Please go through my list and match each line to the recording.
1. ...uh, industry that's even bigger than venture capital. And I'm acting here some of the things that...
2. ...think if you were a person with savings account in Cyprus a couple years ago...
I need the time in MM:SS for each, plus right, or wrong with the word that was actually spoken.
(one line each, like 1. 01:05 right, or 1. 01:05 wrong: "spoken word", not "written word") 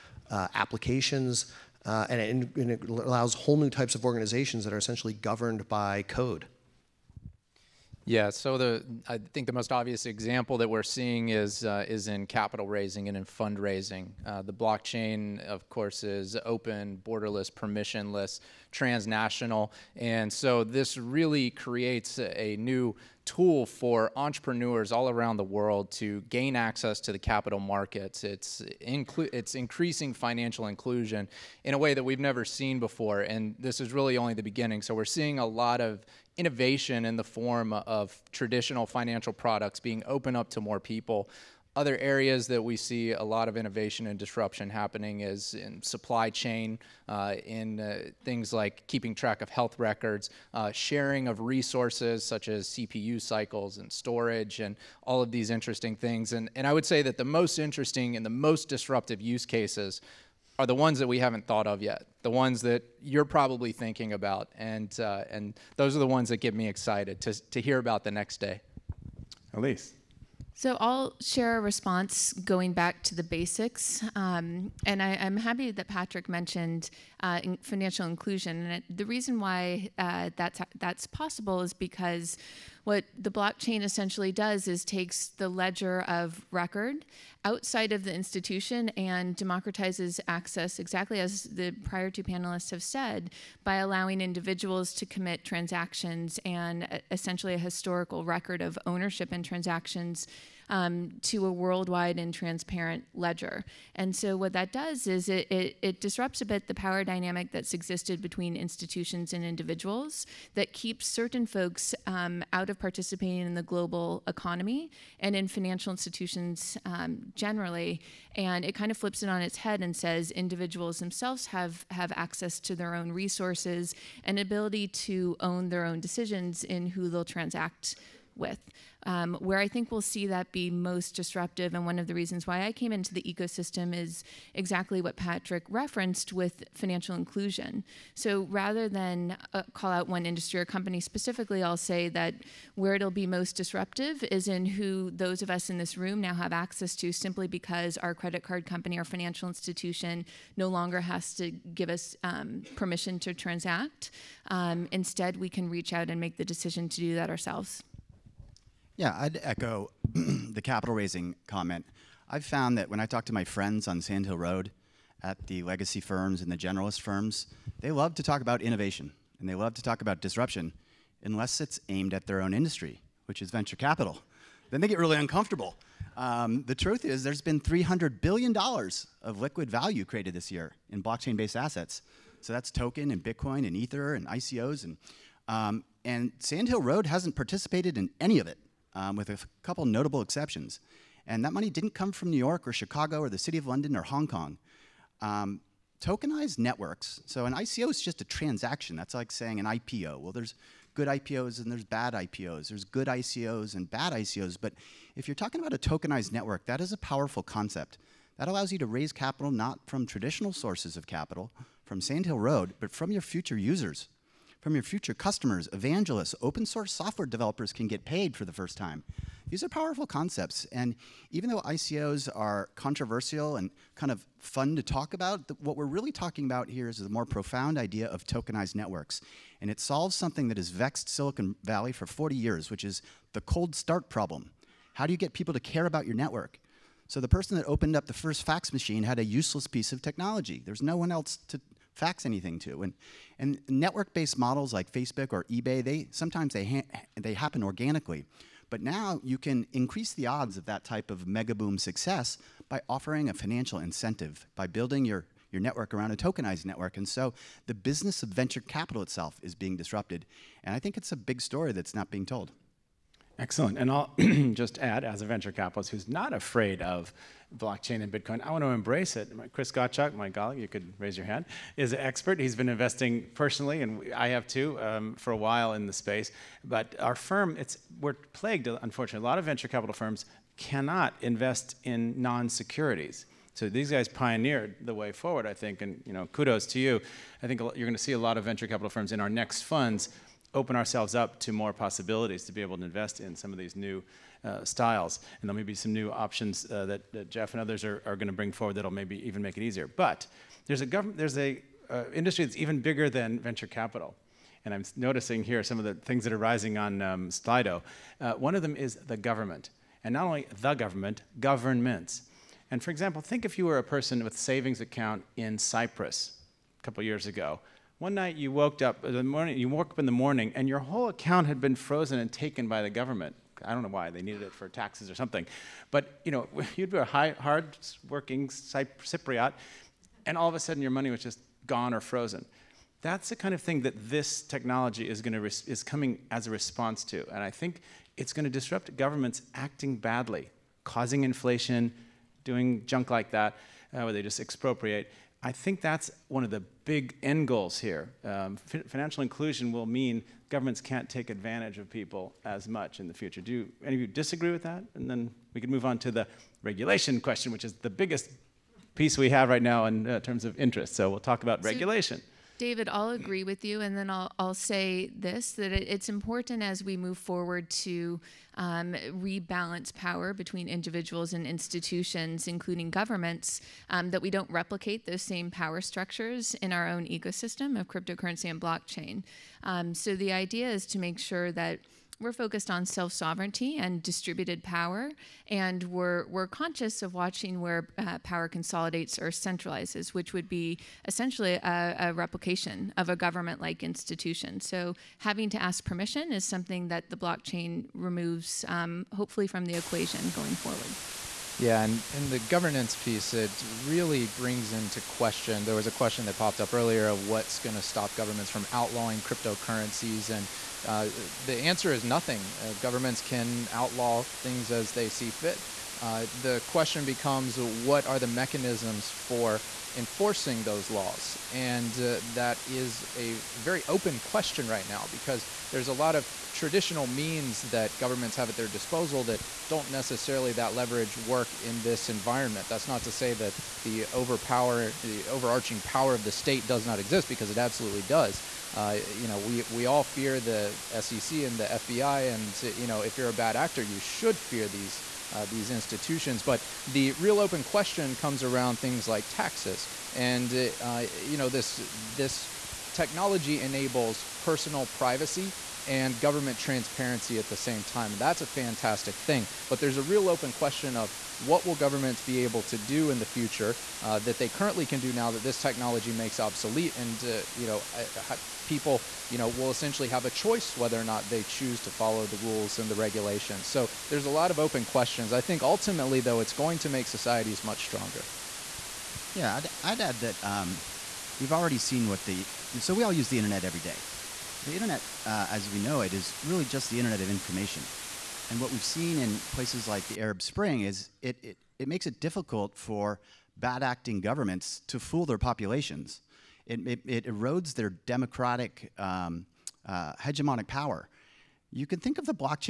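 1. 05:01 wrong: "noticing", not "acting"
2. 05:13 right.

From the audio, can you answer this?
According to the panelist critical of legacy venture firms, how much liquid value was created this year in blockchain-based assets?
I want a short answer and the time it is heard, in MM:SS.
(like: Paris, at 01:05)
$300 billion, at 02:57.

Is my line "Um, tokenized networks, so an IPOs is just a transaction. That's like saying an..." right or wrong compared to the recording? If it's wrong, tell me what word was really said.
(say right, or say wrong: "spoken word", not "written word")
wrong: "ICO", not "IPOs".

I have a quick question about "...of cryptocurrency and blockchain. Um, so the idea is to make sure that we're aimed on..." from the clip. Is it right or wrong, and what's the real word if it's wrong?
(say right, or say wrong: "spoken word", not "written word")
wrong: "focused", not "aimed".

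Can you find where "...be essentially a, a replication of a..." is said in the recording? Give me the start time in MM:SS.
06:30.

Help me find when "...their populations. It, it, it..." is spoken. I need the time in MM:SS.
08:15.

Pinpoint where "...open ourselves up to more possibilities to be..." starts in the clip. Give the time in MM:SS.
04:50.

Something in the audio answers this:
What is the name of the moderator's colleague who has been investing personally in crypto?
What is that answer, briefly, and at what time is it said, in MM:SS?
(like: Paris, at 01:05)
Chris Gottschalk, at 04:29.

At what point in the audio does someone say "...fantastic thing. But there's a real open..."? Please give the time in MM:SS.
07:38.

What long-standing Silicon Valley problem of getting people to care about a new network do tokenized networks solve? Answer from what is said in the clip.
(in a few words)
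Cold start problem.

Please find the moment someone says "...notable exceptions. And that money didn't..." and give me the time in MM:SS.
03:09.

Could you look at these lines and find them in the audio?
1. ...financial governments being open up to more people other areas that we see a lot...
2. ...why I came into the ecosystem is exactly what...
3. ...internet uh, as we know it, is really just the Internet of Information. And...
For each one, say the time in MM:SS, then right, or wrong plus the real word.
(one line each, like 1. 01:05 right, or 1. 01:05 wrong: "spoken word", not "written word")
1. 00:38 wrong: "products", not "governments"
2. 02:12 right
3. 08:04 right.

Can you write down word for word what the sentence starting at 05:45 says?
I think that's one of the big end goals here.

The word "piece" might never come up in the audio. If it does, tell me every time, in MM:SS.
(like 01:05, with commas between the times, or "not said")
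03:59, 05:58, 06:42.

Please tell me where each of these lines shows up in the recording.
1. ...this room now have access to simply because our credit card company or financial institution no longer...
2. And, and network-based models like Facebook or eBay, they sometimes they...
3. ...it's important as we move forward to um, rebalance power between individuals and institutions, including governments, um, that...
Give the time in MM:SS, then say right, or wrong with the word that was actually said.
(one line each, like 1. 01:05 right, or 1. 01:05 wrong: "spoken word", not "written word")
1. 02:25 right
2. 04:02 right
3. 06:05 right.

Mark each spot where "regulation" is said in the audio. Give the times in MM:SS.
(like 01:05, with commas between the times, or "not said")
05:56, 06:01, 07:52.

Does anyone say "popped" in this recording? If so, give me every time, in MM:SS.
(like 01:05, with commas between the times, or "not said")
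06:46.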